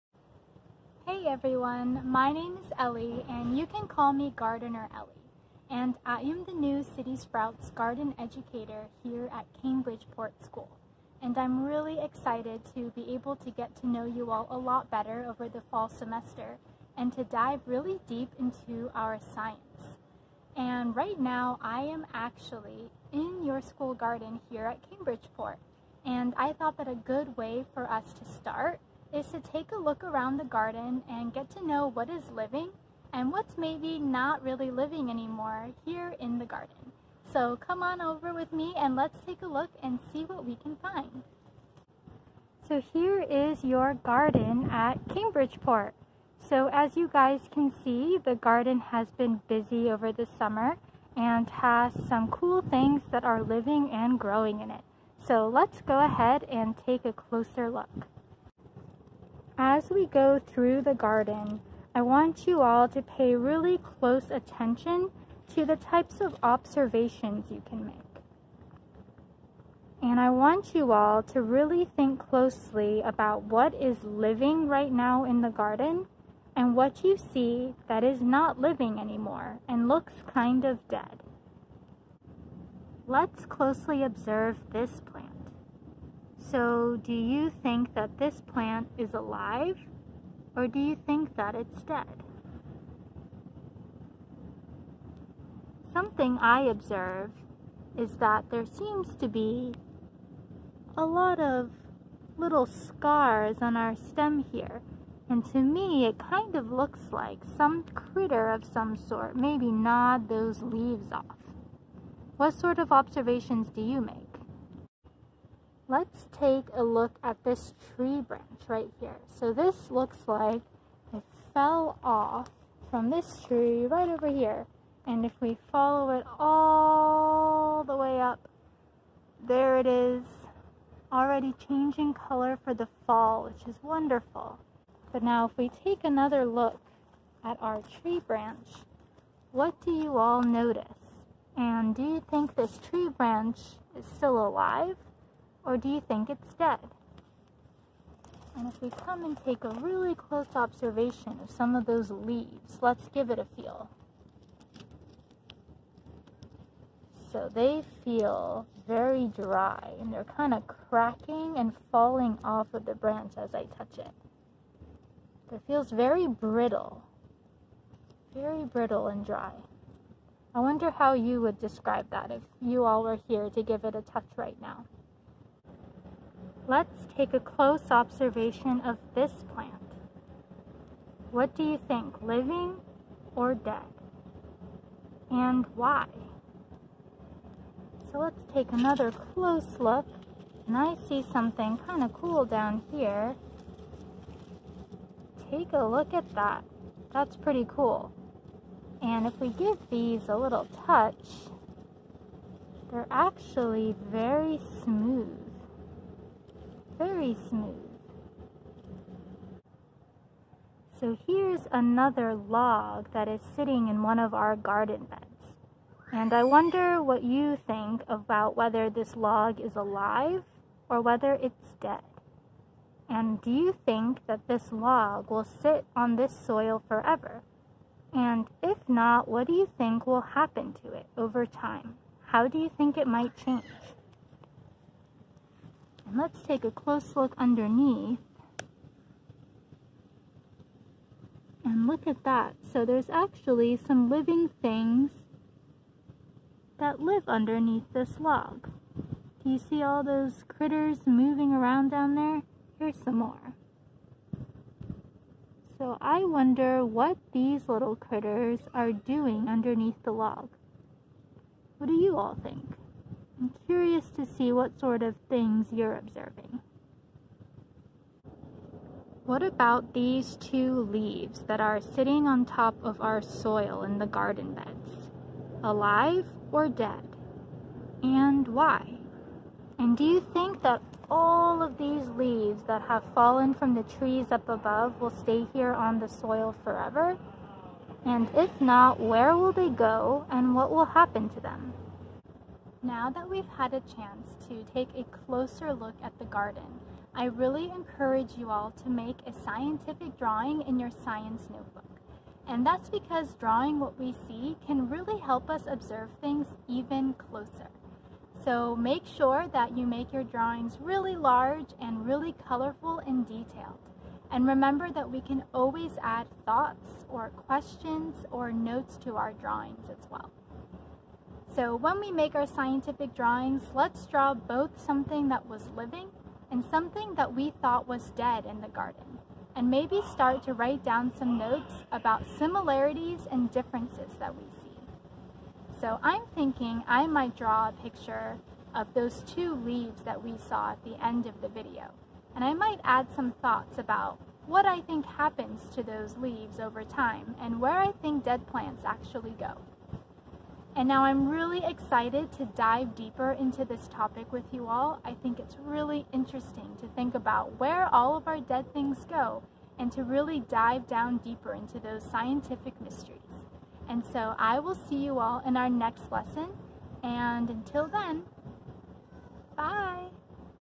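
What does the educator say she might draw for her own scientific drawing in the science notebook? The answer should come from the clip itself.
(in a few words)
those two leaves.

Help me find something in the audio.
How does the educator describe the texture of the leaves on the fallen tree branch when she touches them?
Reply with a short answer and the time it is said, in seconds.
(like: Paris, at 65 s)
very brittle and dry, at 168 s.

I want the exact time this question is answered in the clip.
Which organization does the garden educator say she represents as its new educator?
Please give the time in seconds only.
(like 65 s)
6 s.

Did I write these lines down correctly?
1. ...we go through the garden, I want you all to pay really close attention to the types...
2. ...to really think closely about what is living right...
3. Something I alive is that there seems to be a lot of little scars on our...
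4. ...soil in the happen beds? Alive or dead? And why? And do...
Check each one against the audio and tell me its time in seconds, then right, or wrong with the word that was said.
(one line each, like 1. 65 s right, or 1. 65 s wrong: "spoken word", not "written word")
1. 59 s right
2. 71 s right
3. 95 s wrong: "observe", not "alive"
4. 273 s wrong: "garden", not "happen".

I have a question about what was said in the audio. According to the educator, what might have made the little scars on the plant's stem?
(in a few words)
some critter.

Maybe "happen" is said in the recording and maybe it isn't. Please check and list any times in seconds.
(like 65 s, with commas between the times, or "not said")
230 s, 290 s, 345 s.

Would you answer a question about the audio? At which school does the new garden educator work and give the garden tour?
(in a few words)
Cambridgeport School.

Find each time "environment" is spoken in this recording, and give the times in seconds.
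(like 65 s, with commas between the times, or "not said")
not said.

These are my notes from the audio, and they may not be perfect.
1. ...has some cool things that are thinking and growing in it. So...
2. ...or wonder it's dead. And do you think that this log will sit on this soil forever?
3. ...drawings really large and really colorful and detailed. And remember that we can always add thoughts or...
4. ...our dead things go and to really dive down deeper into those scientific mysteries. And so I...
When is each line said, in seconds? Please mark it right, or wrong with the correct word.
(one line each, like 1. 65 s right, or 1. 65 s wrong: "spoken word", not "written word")
1. 51 s wrong: "living", not "thinking"
2. 220 s wrong: "whether", not "wonder"
3. 310 s right
4. 358 s right.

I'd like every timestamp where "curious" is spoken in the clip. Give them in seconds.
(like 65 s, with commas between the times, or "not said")
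263 s.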